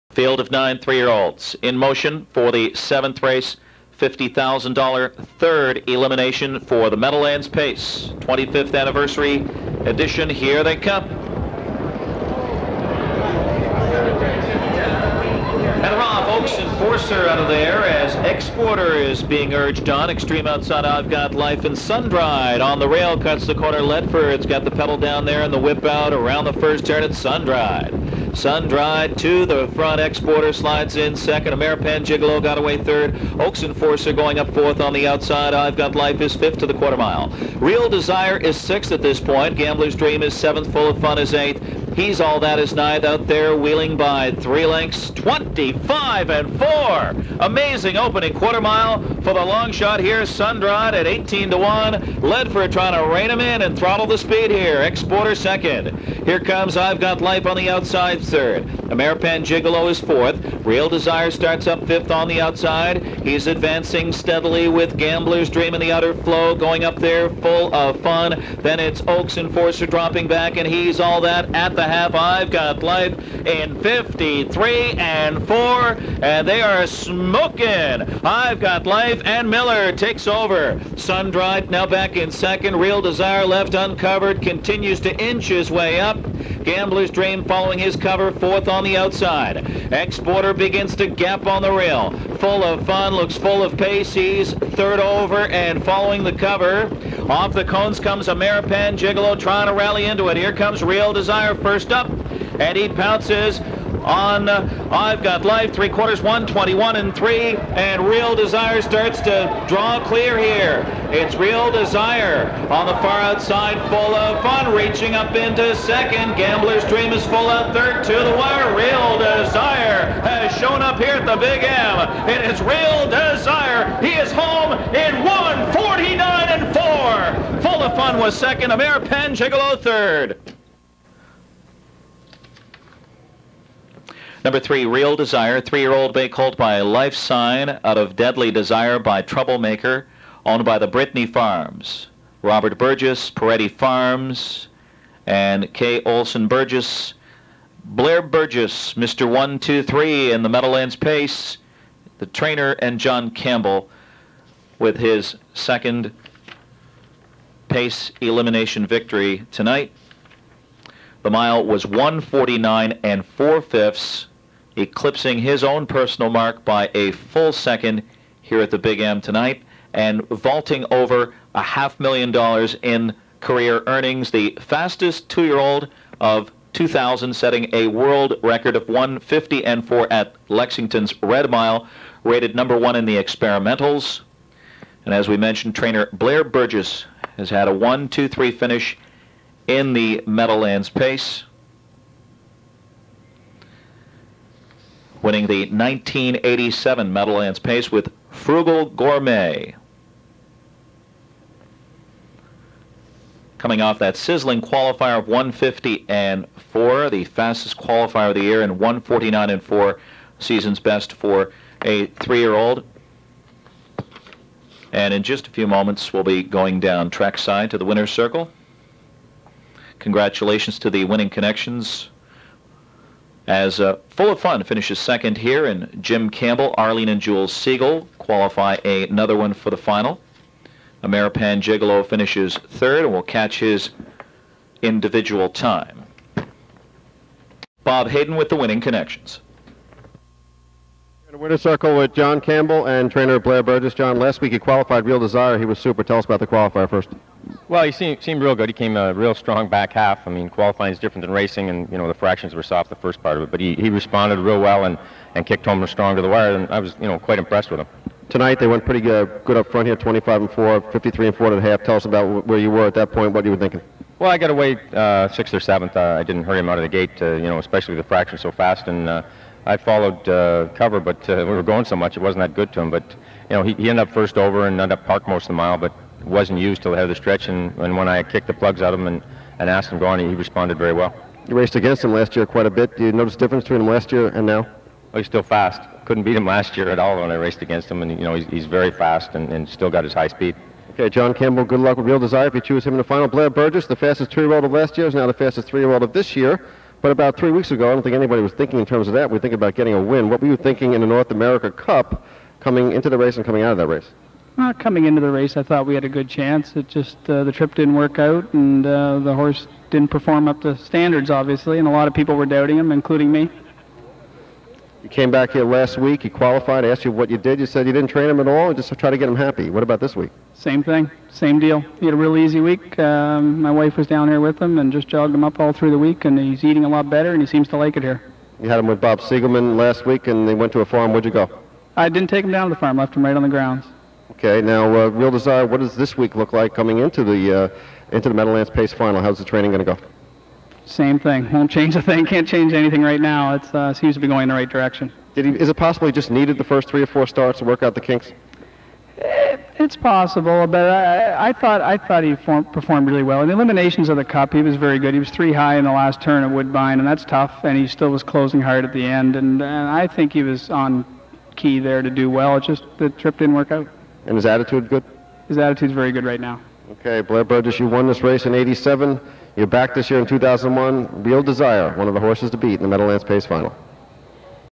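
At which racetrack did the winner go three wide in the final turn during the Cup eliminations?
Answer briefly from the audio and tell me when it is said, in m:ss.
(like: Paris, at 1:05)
Woodbine, at 5:56.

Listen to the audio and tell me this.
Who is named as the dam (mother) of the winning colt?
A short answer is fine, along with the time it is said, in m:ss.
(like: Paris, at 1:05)
Deadly Desire, at 2:18.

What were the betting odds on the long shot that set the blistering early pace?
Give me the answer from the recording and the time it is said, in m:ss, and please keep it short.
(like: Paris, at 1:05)
18 to 1, at 0:51.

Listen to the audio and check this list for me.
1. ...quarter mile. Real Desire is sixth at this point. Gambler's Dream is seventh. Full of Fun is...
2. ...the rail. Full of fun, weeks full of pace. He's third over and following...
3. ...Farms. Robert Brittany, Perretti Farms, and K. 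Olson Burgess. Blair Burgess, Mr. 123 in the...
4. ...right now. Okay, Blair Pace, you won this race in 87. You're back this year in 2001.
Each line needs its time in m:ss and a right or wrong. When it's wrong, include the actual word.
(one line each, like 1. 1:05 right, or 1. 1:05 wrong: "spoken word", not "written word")
1. 0:36 right
2. 1:31 wrong: "looks", not "weeks"
3. 2:21 wrong: "Burgess", not "Brittany"
4. 6:06 wrong: "Burgess", not "Pace".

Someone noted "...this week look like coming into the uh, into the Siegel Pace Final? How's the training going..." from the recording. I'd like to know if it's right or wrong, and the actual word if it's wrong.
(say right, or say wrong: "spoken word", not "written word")
wrong: "Meadowlands", not "Siegel".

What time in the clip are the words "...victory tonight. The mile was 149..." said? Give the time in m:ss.
2:38.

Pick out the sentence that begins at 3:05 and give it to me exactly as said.
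And as we mentioned, trainer Blair Burgess has had a 1-2-3 finish in the Meadowlands pace.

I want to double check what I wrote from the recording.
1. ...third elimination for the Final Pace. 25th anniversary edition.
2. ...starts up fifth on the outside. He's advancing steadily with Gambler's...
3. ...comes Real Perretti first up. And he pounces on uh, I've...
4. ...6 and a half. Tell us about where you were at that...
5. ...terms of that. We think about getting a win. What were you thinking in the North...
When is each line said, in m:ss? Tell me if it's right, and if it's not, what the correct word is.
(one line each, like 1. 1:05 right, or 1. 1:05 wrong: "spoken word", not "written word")
1. 0:05 wrong: "Meadowlands", not "Final"
2. 1:01 right
3. 1:40 wrong: "Desire", not "Perretti"
4. 4:21 wrong: "4", not "6"
5. 4:58 right.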